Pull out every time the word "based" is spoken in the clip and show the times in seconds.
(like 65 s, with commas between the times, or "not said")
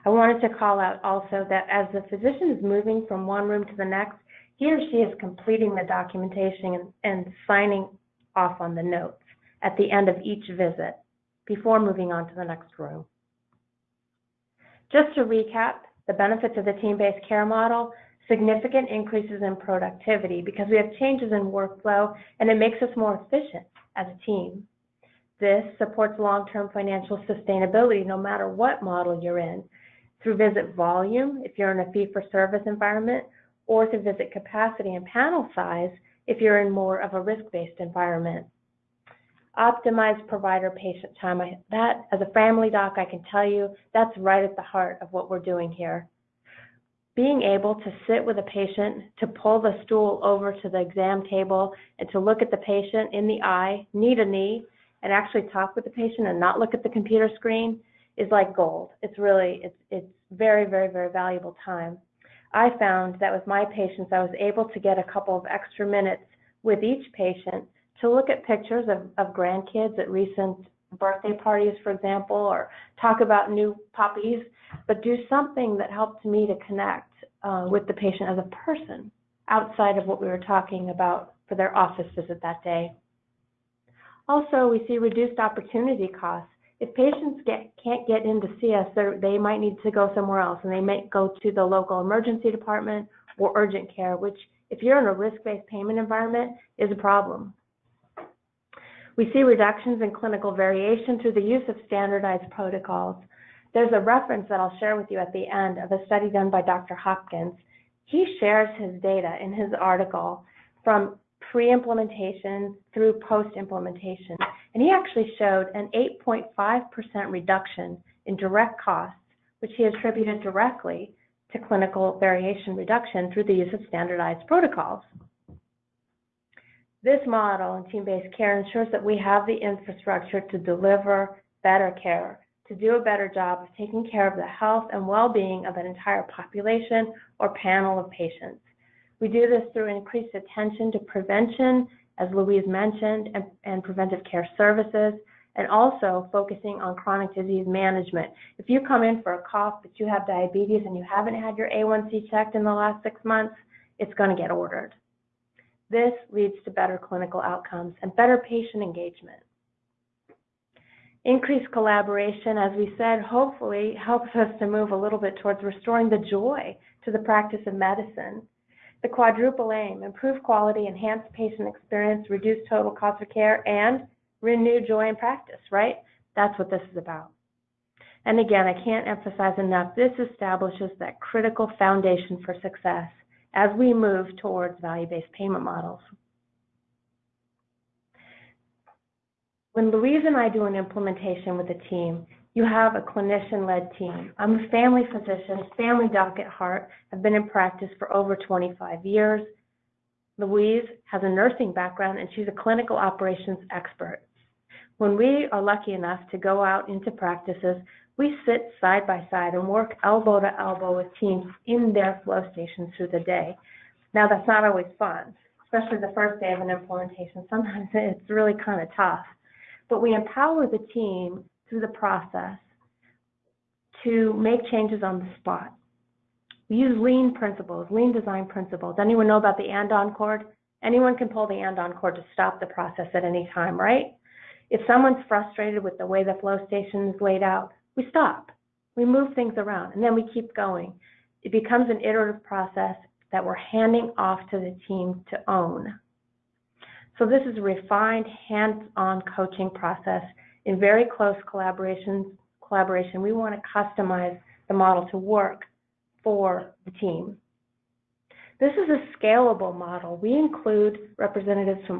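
16 s, 37 s, 95 s, 127 s, 184 s.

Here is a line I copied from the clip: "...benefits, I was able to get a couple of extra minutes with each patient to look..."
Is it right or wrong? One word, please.
wrong.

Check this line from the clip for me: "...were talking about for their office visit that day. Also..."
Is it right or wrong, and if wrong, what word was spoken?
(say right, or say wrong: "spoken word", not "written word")
right.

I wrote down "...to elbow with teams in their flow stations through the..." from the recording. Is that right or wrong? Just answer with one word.
right.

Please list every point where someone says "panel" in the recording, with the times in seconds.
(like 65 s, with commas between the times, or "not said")
35 s, 137 s.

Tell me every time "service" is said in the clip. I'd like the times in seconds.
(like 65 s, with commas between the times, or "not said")
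31 s, 144 s.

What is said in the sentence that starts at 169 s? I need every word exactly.
The quadruple aim, improve quality, enhance patient experience, reduce total cost of care, and renew joy in practice, right?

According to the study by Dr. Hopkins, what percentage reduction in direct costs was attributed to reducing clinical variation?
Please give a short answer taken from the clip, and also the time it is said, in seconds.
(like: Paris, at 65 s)
8.5%, at 116 s.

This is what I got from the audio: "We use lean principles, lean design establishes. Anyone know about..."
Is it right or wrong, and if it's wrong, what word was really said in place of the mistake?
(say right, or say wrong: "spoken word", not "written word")
wrong: "principles", not "establishes".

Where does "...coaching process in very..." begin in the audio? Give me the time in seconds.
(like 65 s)
249 s.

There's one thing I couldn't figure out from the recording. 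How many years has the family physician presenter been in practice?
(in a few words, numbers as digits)
over 25 years.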